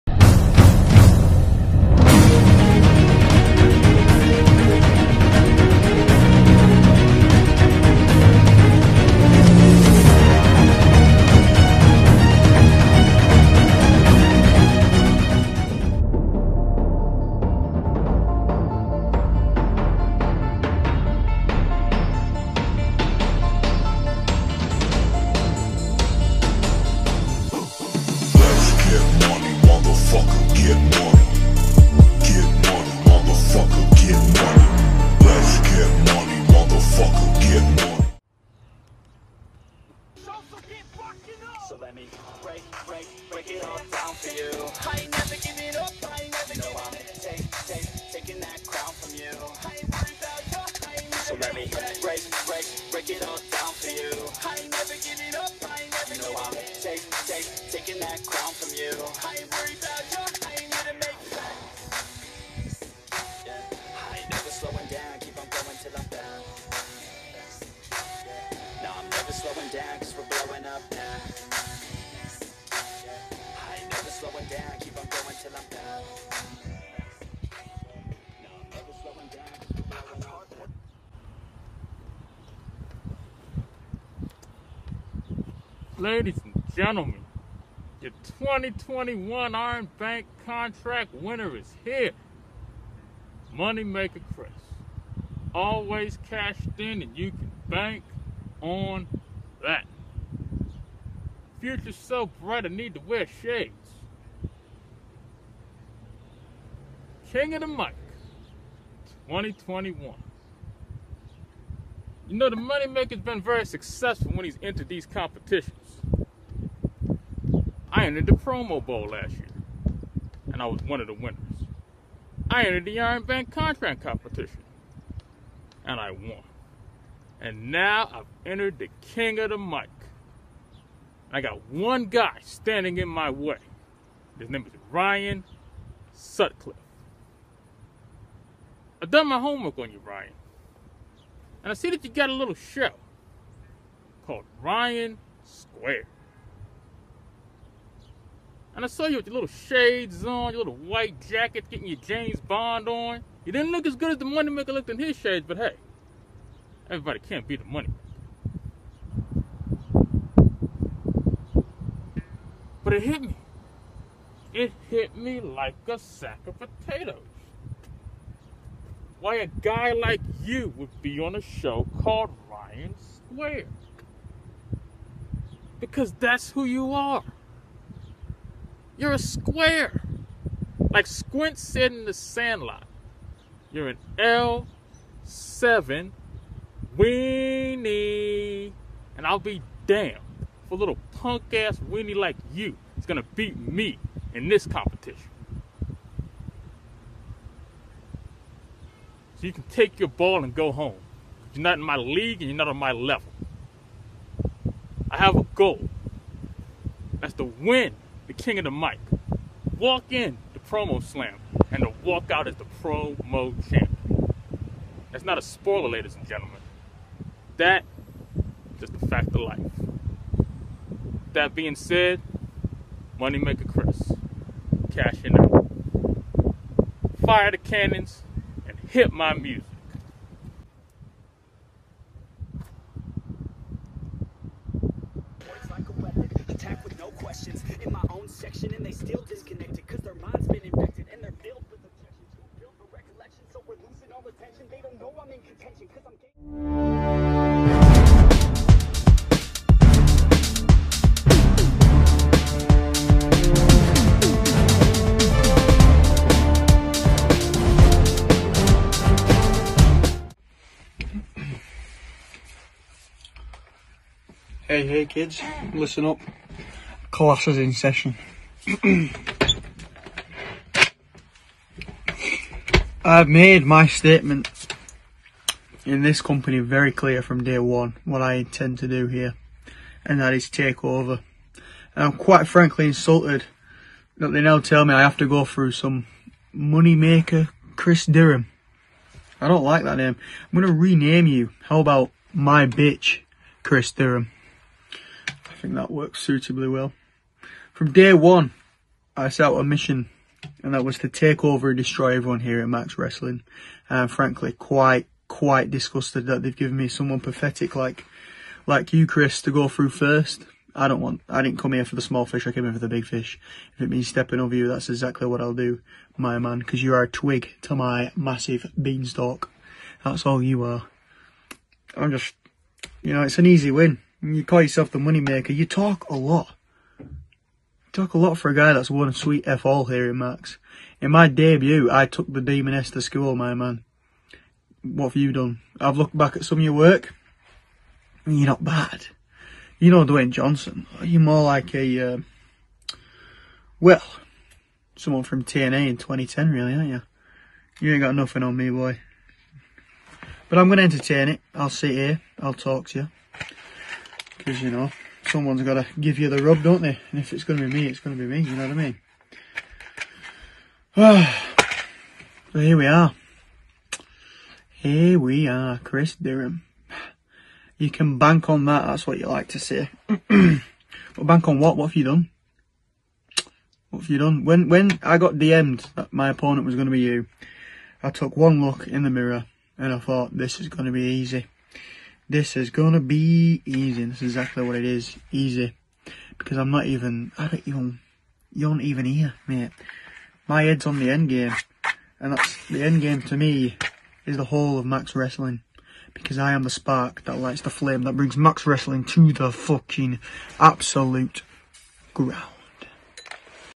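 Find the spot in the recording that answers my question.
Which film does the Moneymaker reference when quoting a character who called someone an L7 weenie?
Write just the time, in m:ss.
3:02.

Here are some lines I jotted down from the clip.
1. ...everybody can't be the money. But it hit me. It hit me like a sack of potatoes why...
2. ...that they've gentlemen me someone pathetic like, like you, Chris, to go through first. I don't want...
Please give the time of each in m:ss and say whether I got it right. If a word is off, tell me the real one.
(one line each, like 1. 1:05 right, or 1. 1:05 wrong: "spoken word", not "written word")
1. 2:36 right
2. 5:06 wrong: "given", not "gentlemen".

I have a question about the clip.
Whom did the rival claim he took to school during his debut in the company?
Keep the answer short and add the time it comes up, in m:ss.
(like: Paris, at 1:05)
the Demoness, at 5:32.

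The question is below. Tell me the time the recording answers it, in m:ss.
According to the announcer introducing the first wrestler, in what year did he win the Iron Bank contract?
1:28.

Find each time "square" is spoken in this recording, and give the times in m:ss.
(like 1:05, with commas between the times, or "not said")
2:25, 2:52, 2:59.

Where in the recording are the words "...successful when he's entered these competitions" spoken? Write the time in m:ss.
1:53.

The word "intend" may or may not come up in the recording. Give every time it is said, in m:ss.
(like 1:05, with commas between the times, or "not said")
4:38.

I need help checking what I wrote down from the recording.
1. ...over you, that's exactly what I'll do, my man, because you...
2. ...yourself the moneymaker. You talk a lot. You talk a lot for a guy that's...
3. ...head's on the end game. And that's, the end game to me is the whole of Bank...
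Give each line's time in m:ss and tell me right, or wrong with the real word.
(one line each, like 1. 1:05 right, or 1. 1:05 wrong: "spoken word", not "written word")
1. 5:14 right
2. 5:24 right
3. 6:30 wrong: "Max", not "Bank".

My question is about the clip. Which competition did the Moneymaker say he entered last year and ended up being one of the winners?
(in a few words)
Promo Bowl.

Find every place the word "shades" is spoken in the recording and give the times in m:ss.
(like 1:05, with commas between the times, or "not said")
1:43, 2:29, 2:35.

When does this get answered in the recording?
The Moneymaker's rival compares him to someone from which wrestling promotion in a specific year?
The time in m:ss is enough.
5:45.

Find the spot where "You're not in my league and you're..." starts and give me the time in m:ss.
3:21.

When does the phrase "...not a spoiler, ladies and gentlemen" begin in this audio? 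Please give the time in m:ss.
3:35.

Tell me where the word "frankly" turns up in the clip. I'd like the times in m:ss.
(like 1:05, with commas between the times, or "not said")
4:42, 5:04.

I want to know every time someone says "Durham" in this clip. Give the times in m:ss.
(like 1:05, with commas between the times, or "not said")
4:48, 4:53, 6:06.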